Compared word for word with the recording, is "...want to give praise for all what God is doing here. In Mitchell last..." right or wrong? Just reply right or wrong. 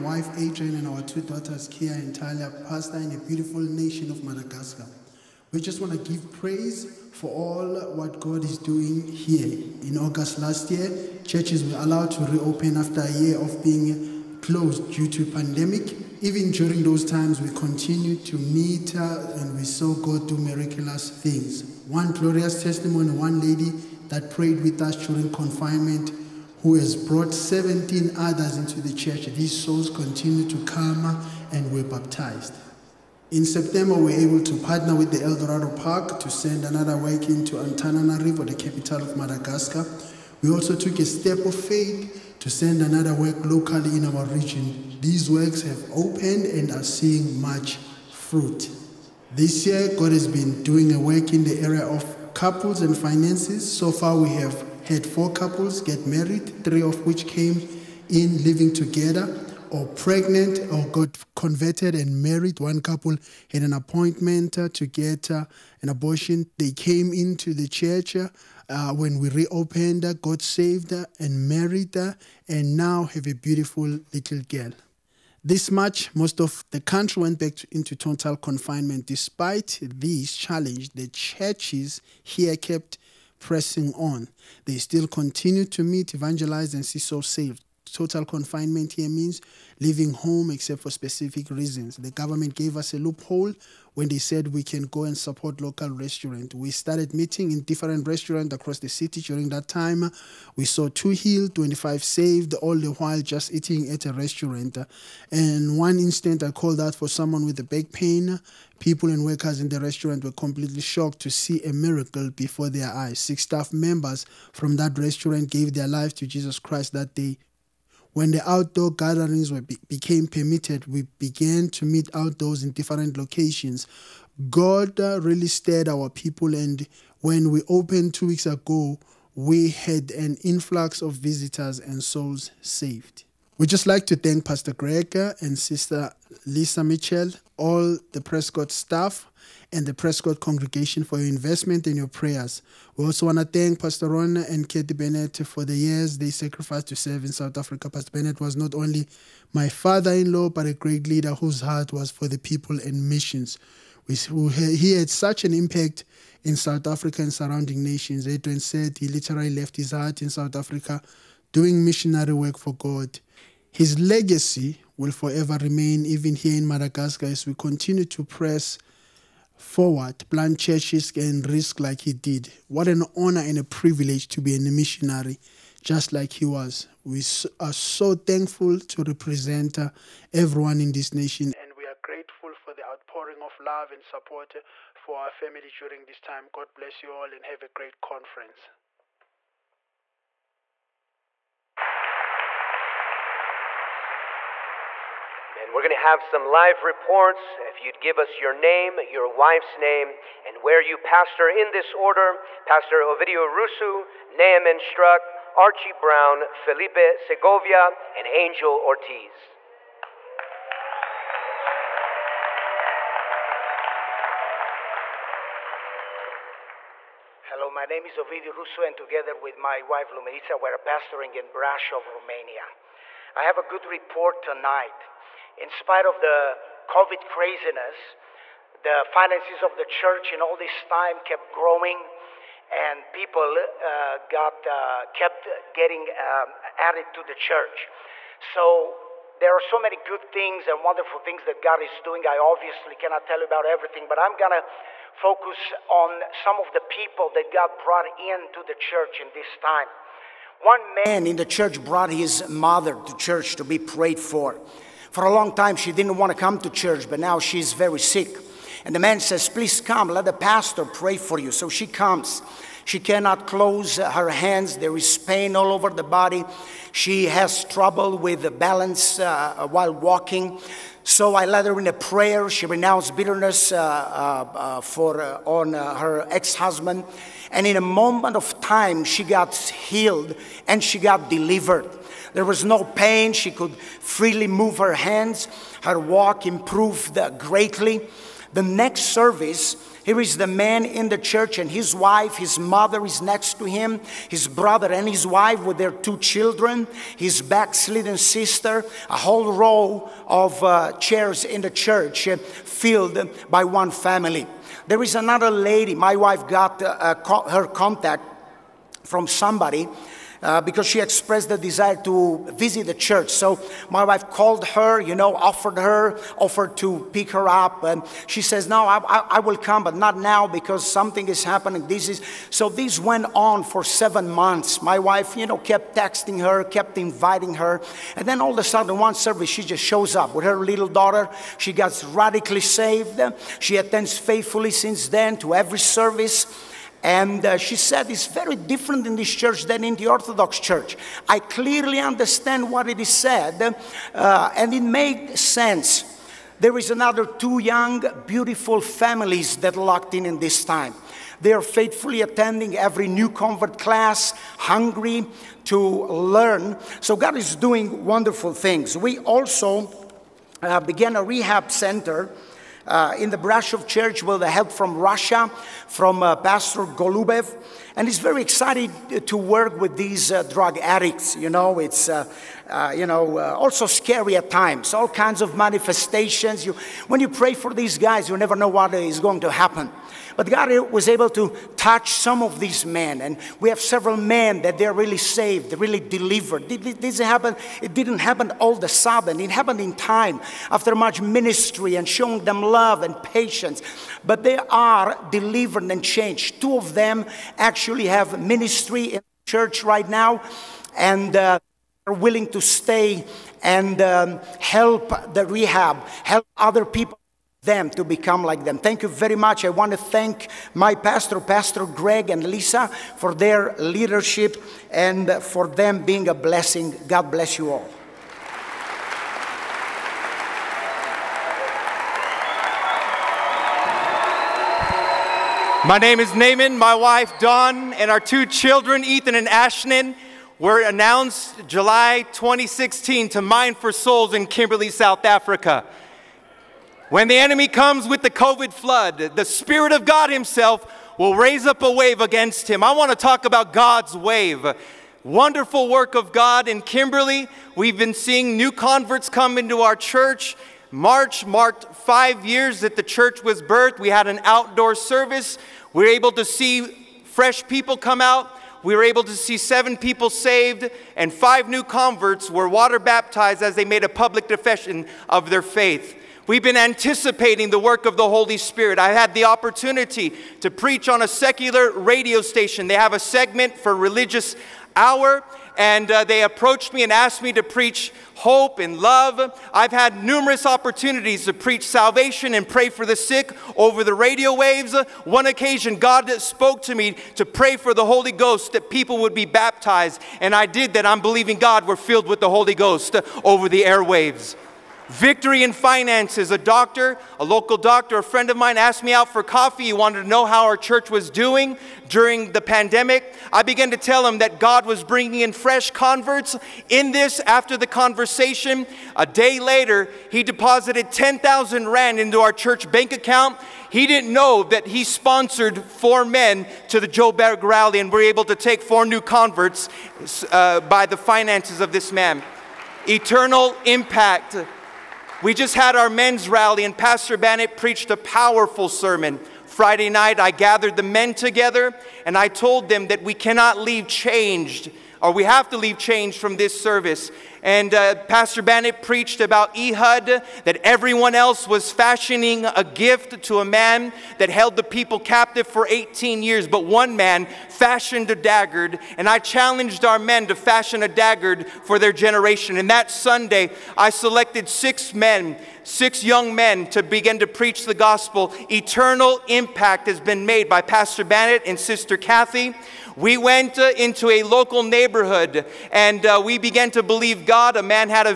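wrong.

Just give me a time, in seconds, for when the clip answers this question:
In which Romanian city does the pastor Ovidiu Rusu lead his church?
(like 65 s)
221 s.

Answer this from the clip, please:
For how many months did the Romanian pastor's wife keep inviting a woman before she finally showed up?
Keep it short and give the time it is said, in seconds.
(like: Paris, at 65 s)
7, at 323 s.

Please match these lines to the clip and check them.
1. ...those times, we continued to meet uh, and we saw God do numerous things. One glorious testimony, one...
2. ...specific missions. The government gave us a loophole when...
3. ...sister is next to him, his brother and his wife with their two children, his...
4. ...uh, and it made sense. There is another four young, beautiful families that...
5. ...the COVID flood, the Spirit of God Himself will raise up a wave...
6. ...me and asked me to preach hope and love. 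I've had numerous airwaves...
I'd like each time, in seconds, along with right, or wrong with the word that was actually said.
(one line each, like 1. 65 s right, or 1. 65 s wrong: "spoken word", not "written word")
1. 16 s wrong: "miraculous", not "numerous"
2. 90 s wrong: "reasons", not "missions"
3. 292 s wrong: "mother", not "sister"
4. 344 s wrong: "two", not "four"
5. 438 s right
6. 476 s wrong: "opportunities", not "airwaves".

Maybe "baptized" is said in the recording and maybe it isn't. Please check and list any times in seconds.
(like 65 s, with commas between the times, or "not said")
31 s, 462 s, 489 s.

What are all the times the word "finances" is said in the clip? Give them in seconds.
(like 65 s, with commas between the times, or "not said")
52 s, 229 s, 495 s, 521 s.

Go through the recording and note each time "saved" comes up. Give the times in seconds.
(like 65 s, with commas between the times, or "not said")
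70 s, 87 s, 102 s, 132 s, 332 s, 385 s, 460 s.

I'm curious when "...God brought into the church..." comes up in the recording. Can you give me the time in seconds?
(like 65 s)
247 s.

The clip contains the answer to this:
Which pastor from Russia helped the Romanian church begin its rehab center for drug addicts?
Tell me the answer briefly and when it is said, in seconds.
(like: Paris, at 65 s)
Pastor Golubev, at 366 s.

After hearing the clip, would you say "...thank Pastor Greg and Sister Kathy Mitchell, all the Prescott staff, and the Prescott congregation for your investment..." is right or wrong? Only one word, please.
wrong.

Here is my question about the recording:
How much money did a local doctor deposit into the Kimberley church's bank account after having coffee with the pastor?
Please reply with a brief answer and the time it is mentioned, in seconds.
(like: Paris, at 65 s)
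10,000 Rand, at 511 s.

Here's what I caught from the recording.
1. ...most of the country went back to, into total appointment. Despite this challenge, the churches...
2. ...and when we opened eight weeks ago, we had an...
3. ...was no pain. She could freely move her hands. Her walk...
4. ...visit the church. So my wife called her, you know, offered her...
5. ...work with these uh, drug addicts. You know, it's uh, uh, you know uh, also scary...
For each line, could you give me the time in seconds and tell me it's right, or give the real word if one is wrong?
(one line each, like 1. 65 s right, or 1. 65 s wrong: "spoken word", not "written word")
1. 76 s wrong: "confinement", not "appointment"
2. 126 s wrong: "two", not "eight"
3. 282 s right
4. 312 s right
5. 369 s right.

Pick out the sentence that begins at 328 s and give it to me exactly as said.
And then all of a sudden, one service, she just shows up with her little daughter.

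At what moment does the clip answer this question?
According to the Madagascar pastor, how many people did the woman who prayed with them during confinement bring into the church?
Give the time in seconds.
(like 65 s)
27 s.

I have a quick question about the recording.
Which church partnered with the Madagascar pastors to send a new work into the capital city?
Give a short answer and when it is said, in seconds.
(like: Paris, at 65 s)
Eldorado Park, at 35 s.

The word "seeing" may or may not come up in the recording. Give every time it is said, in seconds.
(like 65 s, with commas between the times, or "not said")
46 s, 448 s.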